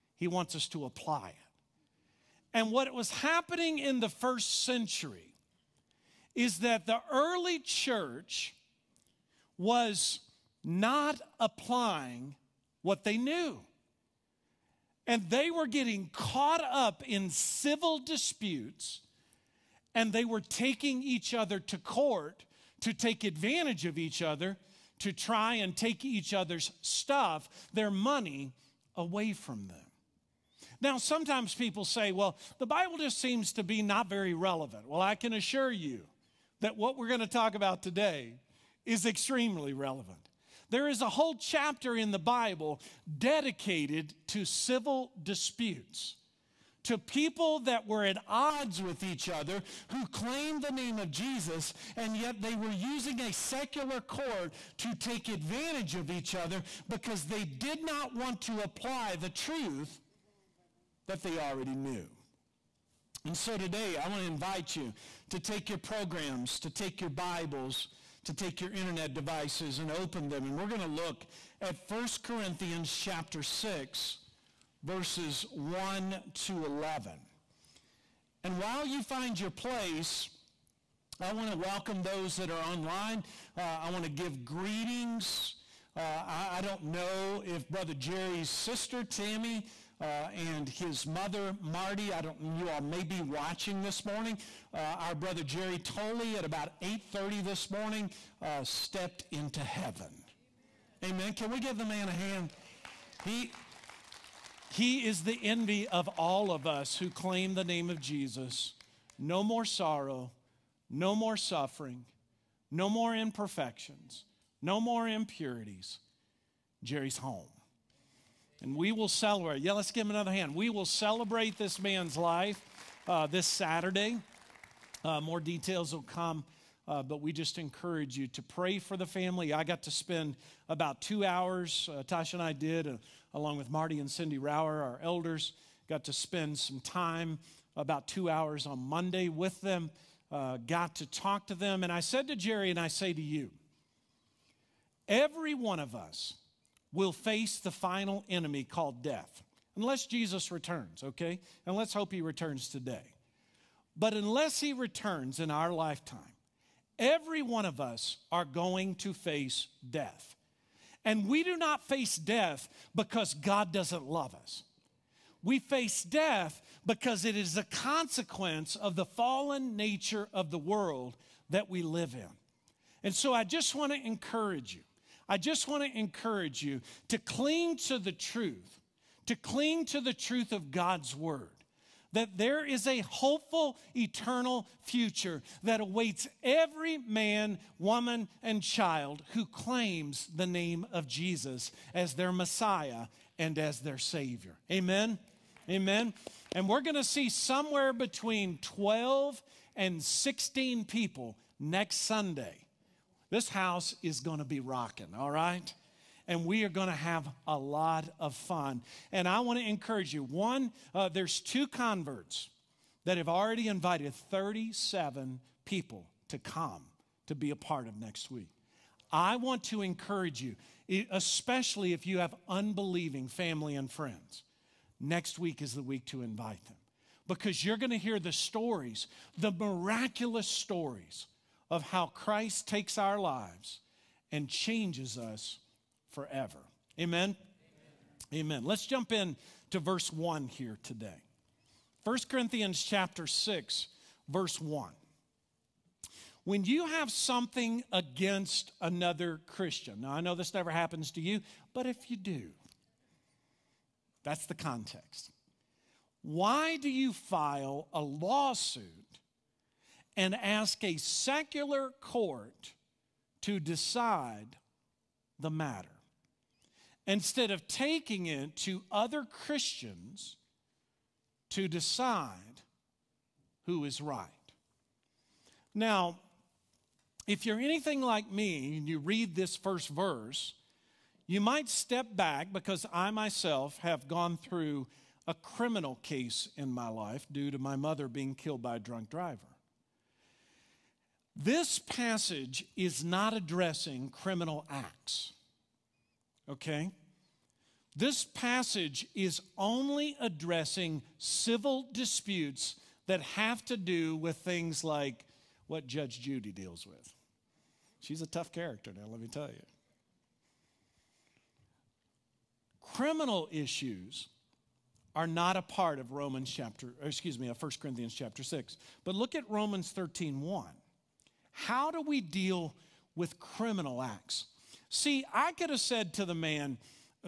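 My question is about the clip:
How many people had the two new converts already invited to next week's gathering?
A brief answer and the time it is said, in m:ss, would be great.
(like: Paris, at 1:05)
37, at 3:34.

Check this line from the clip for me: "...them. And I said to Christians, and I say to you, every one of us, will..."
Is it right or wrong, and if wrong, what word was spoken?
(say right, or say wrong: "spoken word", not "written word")
wrong: "Jerry", not "Christians".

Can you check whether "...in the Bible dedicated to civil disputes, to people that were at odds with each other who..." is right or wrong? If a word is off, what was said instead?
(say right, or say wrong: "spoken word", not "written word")
right.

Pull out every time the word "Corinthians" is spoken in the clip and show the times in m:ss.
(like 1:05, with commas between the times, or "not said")
1:12, 4:02, 5:17.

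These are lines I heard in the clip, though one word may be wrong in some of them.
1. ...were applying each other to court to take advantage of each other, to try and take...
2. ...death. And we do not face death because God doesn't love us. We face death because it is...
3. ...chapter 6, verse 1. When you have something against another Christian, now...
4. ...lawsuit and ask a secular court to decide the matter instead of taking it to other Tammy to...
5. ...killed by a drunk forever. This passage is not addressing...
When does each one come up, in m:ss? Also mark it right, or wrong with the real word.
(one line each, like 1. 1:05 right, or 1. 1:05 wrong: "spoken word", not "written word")
1. 0:20 wrong: "taking", not "applying"
2. 2:39 right
3. 4:02 right
4. 4:18 wrong: "Christians", not "Tammy"
5. 4:48 wrong: "driver", not "forever".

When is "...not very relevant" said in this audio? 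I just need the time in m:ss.
0:33.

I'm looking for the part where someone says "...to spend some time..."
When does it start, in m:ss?
2:16.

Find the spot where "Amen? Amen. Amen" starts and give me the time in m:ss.
3:56.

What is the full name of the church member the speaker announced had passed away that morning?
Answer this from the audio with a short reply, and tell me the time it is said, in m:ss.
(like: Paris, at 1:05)
Jerry Tolley, at 1:35.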